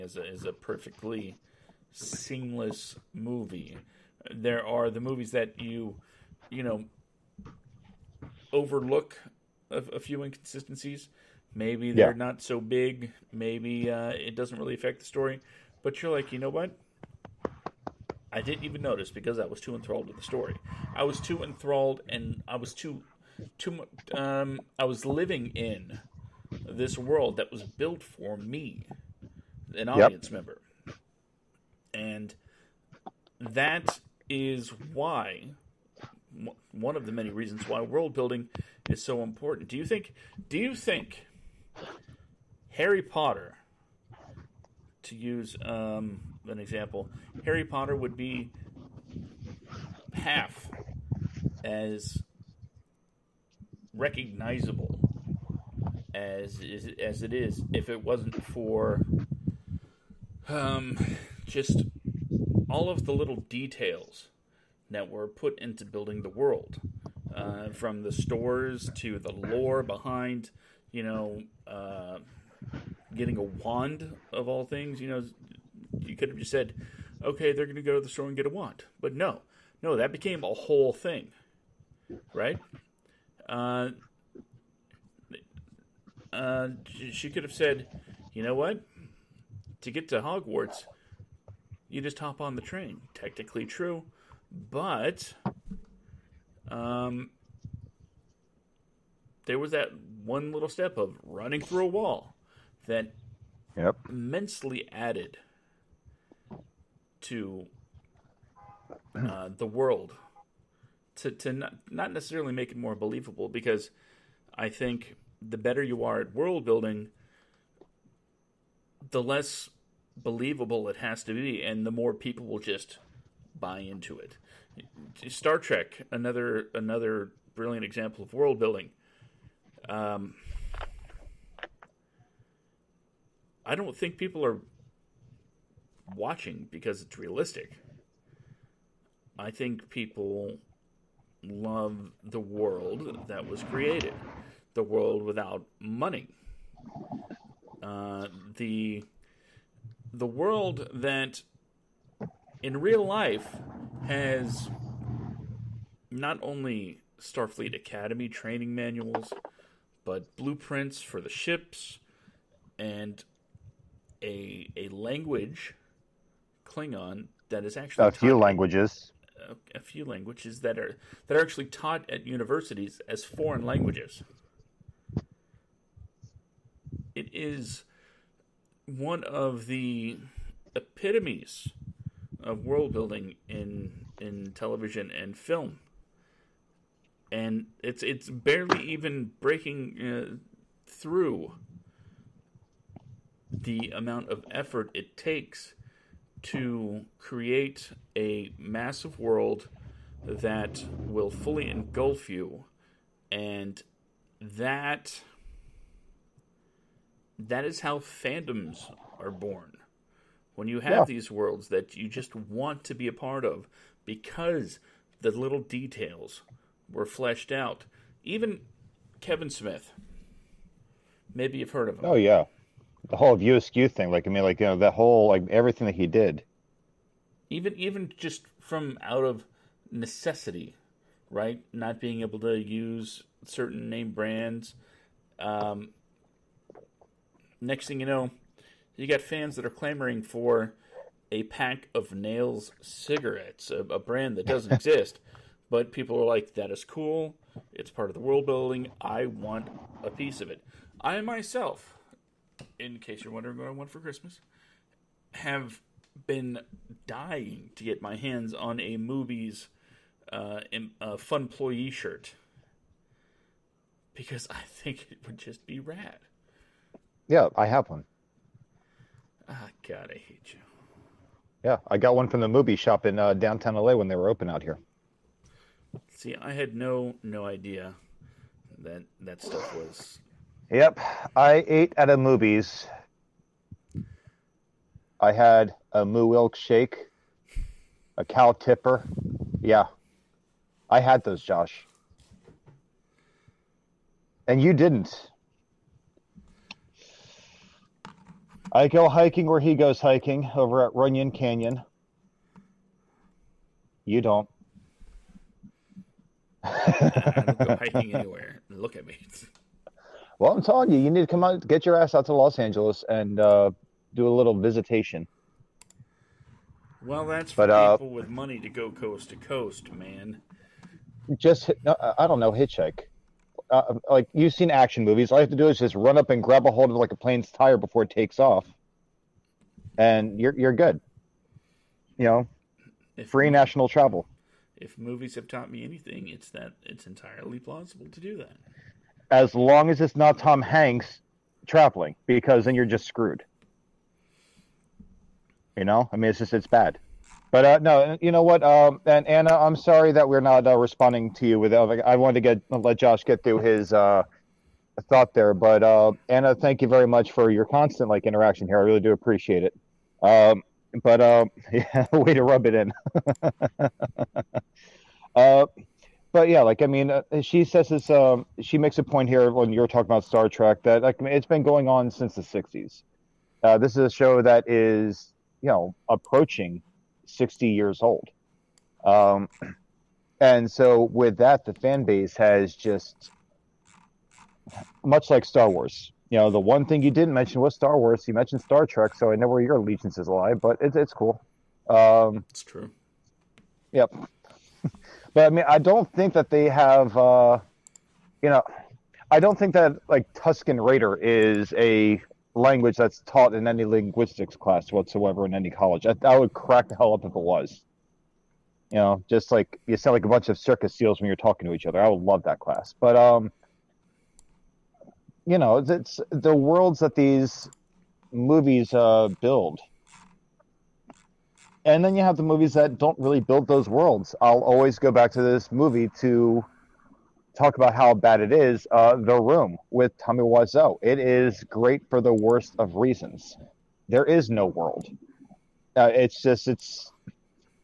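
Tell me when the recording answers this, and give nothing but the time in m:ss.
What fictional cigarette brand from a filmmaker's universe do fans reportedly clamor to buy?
4:02.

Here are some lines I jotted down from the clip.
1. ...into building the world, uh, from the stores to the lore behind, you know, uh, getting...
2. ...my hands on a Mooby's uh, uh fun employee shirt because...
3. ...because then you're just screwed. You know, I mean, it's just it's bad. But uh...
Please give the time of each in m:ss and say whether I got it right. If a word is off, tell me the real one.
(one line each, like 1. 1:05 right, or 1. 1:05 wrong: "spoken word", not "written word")
1. 1:05 right
2. 4:18 right
3. 5:42 right.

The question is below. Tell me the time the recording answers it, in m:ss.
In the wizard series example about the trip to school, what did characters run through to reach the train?
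1:41.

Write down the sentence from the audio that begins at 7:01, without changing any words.
And then you have the movies that don't really build those worlds.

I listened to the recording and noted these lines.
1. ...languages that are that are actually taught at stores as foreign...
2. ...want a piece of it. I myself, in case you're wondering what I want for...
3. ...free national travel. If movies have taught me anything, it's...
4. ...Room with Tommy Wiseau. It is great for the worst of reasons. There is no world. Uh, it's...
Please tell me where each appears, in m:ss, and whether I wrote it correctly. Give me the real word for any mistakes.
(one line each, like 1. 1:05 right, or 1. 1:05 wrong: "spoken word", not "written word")
1. 2:50 wrong: "universities", not "stores"
2. 4:09 right
3. 5:33 right
4. 7:09 right.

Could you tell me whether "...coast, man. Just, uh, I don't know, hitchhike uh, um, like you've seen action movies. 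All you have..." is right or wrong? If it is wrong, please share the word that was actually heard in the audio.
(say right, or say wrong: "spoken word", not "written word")
right.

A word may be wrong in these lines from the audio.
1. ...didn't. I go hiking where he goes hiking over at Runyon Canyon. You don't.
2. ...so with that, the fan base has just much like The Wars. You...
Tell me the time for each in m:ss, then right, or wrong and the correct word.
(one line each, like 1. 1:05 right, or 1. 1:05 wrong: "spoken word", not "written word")
1. 4:54 right
2. 6:20 wrong: "Star", not "The".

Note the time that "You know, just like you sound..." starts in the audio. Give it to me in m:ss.
6:48.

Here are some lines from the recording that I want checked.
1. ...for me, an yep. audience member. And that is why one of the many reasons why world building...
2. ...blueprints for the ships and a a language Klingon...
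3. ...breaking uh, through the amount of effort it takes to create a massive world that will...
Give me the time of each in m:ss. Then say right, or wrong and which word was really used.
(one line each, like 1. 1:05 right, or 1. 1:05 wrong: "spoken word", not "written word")
1. 0:28 right
2. 2:40 right
3. 3:09 right.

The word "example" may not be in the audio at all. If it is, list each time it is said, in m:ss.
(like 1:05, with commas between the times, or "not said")
0:46, 2:07.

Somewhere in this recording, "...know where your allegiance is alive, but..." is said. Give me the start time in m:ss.
6:29.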